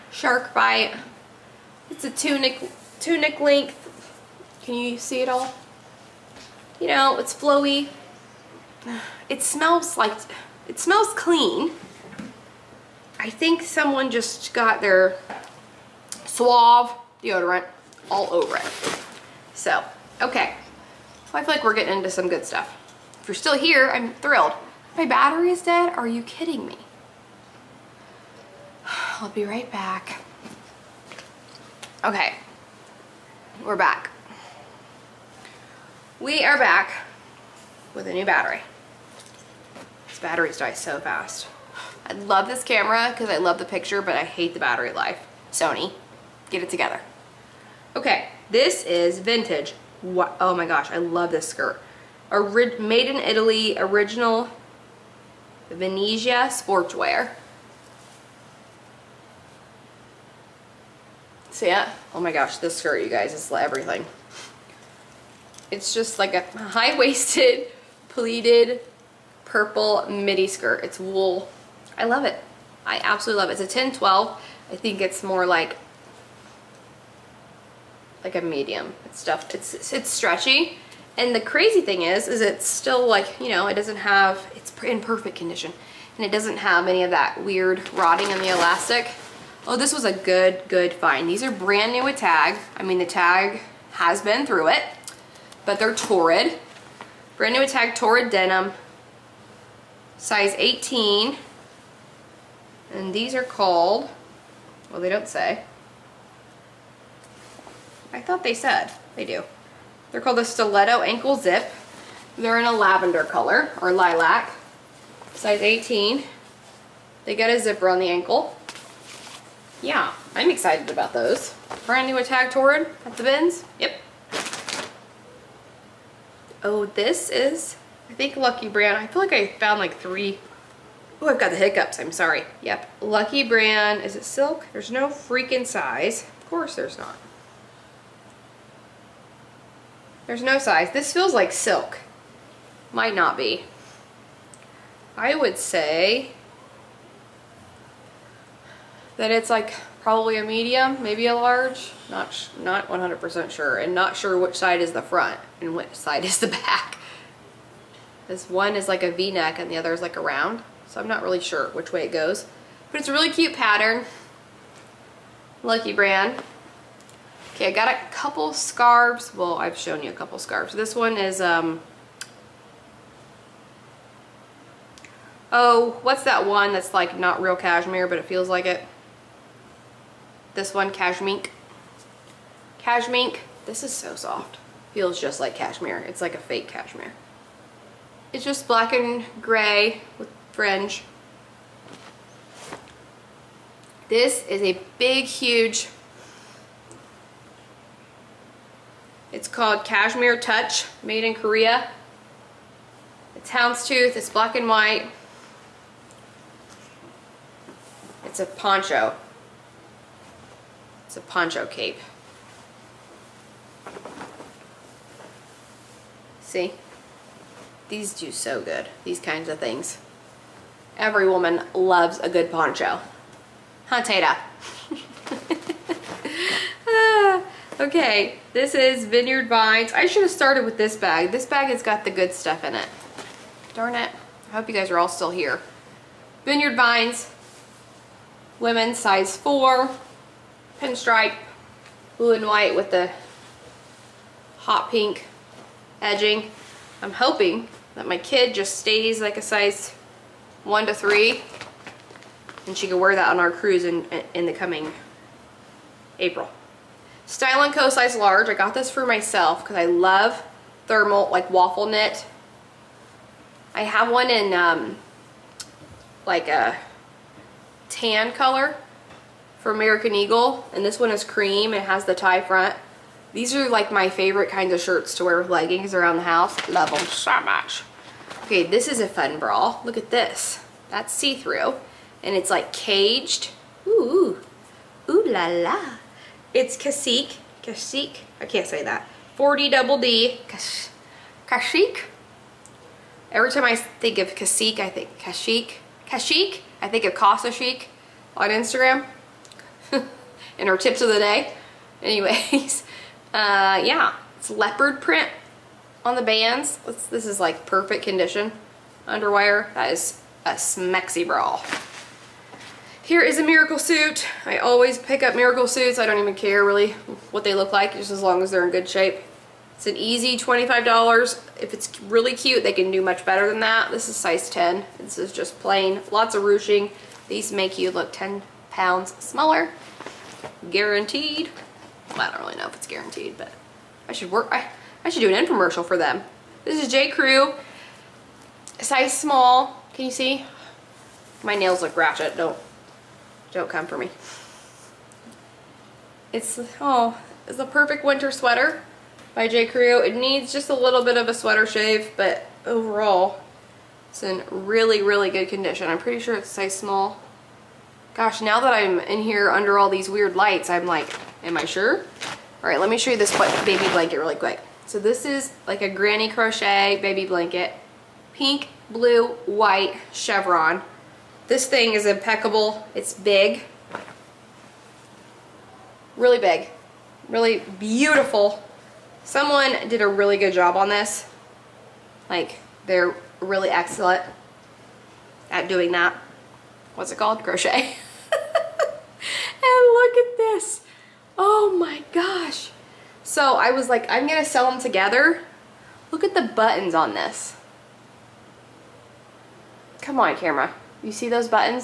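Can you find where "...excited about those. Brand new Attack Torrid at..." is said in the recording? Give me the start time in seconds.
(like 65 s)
120 s.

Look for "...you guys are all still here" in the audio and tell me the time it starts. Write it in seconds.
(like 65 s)
234 s.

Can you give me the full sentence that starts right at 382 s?
Like, they're really excellent at doing that.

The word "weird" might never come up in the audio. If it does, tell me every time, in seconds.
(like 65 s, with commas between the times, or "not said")
87 s, 360 s.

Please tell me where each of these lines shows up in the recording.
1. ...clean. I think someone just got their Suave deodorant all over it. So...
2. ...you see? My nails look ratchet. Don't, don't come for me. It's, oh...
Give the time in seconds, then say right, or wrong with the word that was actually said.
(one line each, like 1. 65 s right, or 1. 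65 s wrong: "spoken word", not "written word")
1. 11 s right
2. 340 s right.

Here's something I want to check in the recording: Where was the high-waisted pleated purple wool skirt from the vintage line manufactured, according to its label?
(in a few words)
Italy.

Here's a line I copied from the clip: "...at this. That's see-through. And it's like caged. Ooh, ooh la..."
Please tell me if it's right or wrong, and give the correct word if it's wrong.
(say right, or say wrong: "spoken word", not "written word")
right.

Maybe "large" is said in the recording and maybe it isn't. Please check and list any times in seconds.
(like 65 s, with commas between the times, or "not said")
151 s, 258 s.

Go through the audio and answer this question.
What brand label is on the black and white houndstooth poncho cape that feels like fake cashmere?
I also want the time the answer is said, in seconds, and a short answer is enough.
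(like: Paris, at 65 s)
Cashmere Touch, at 199 s.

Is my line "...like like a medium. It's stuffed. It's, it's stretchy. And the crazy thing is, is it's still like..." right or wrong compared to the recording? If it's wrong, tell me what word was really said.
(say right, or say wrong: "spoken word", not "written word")
right.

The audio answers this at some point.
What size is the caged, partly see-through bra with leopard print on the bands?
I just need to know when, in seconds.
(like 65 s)
289 s.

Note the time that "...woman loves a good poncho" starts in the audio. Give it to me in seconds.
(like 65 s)
221 s.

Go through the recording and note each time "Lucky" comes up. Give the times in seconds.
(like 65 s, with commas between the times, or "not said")
128 s, 133 s, 165 s.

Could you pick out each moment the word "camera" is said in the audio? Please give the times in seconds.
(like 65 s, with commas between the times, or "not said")
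42 s, 400 s.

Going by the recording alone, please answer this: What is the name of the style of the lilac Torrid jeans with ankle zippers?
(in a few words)
Stiletto Ankle Zip.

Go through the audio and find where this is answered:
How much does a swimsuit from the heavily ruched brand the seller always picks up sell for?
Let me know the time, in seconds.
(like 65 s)
320 s.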